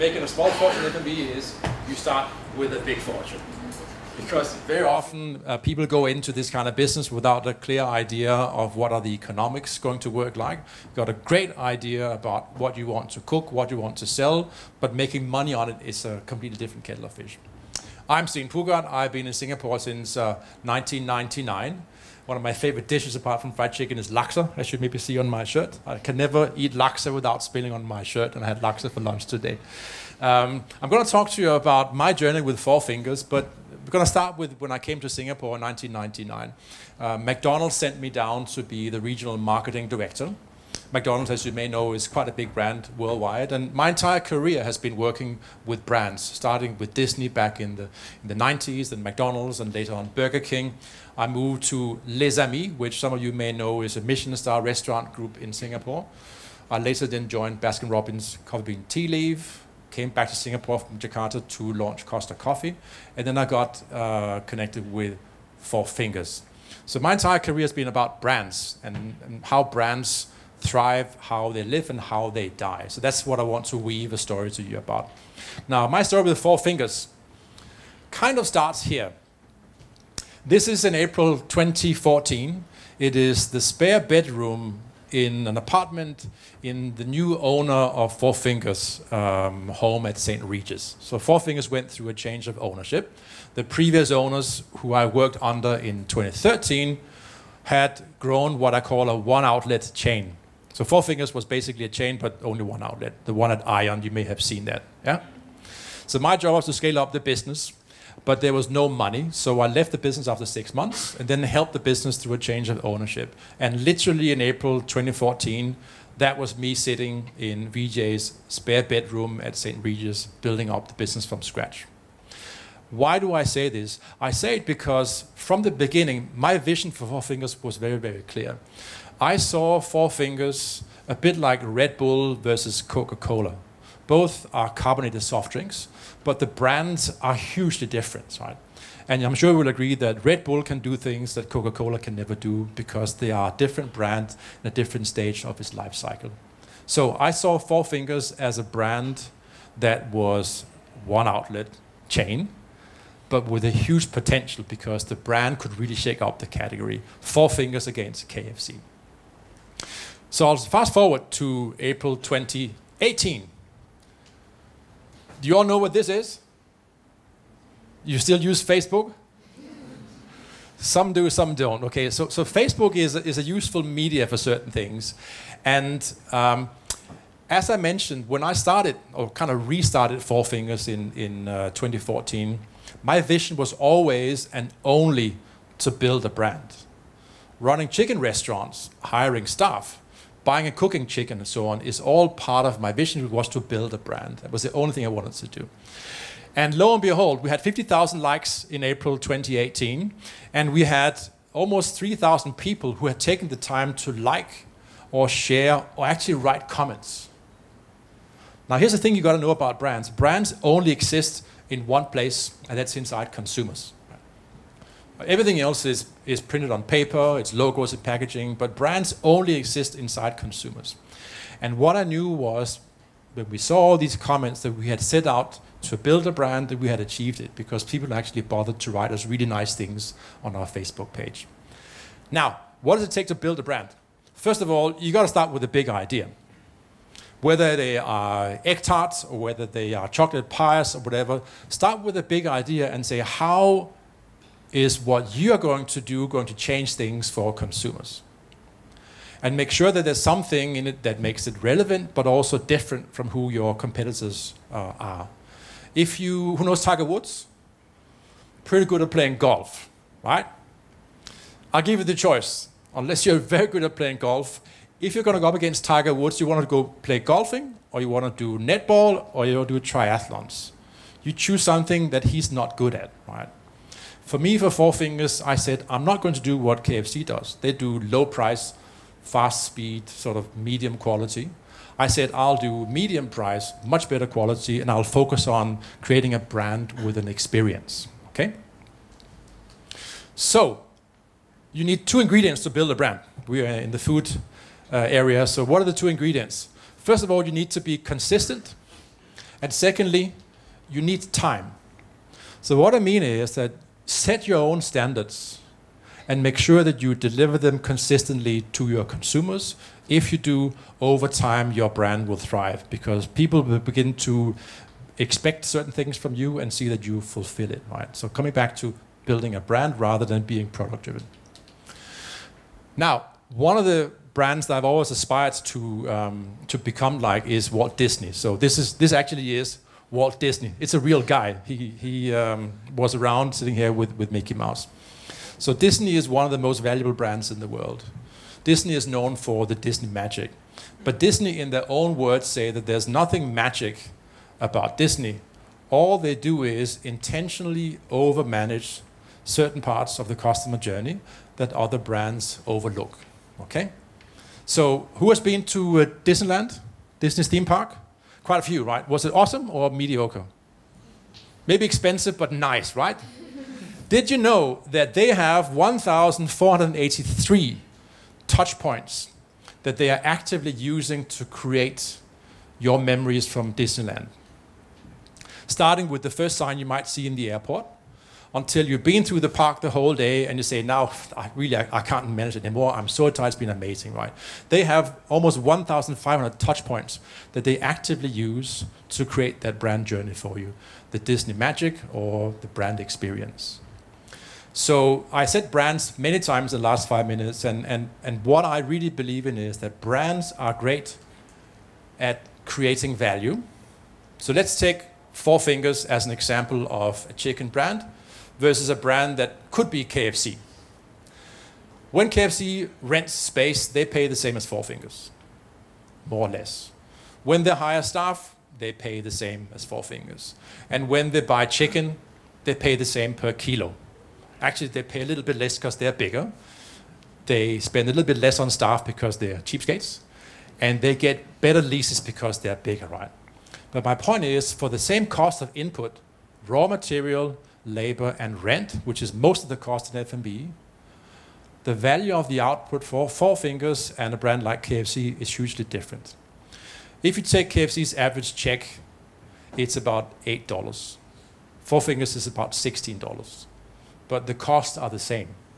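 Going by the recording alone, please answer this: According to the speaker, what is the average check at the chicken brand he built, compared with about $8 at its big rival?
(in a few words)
$16.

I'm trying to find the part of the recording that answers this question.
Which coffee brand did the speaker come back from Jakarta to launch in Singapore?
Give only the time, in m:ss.
1:02.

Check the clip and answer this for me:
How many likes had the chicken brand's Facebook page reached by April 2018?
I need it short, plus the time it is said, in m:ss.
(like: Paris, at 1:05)
50,000, at 3:17.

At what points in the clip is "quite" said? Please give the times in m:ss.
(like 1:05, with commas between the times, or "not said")
0:42, 5:58.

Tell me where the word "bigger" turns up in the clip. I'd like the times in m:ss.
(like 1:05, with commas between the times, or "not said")
7:06, 7:12.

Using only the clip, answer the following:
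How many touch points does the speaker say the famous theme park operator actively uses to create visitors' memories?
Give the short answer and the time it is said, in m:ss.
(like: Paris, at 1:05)
1,483, at 6:05.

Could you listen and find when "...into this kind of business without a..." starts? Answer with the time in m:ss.
0:06.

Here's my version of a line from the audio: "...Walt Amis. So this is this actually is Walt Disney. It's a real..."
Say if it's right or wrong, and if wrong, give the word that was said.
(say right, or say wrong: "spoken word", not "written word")
wrong: "Disney", not "Amis".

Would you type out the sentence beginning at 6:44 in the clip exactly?
So let's take Four Fingers as an example of a chicken brand versus a brand that could be KFC.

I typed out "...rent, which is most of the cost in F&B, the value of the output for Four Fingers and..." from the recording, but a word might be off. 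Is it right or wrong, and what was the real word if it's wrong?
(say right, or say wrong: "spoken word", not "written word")
right.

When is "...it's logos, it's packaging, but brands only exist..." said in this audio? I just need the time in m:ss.
3:37.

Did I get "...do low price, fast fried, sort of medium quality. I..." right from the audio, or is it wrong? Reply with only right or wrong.
wrong.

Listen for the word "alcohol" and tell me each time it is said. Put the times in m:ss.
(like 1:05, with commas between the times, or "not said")
not said.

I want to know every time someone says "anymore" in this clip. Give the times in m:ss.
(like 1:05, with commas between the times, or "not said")
6:22.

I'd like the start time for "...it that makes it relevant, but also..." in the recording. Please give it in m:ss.
4:10.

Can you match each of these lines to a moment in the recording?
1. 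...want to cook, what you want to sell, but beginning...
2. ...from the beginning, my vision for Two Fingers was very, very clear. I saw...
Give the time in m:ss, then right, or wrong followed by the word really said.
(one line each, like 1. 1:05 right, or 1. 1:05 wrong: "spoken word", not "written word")
1. 0:12 wrong: "making", not "beginning"
2. 2:05 wrong: "Four", not "Two".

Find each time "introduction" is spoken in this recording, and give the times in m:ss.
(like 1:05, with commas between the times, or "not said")
not said.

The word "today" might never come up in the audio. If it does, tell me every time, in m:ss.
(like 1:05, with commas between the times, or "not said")
0:29.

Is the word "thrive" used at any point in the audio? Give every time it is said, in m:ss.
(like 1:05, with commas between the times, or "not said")
1:10, 5:12.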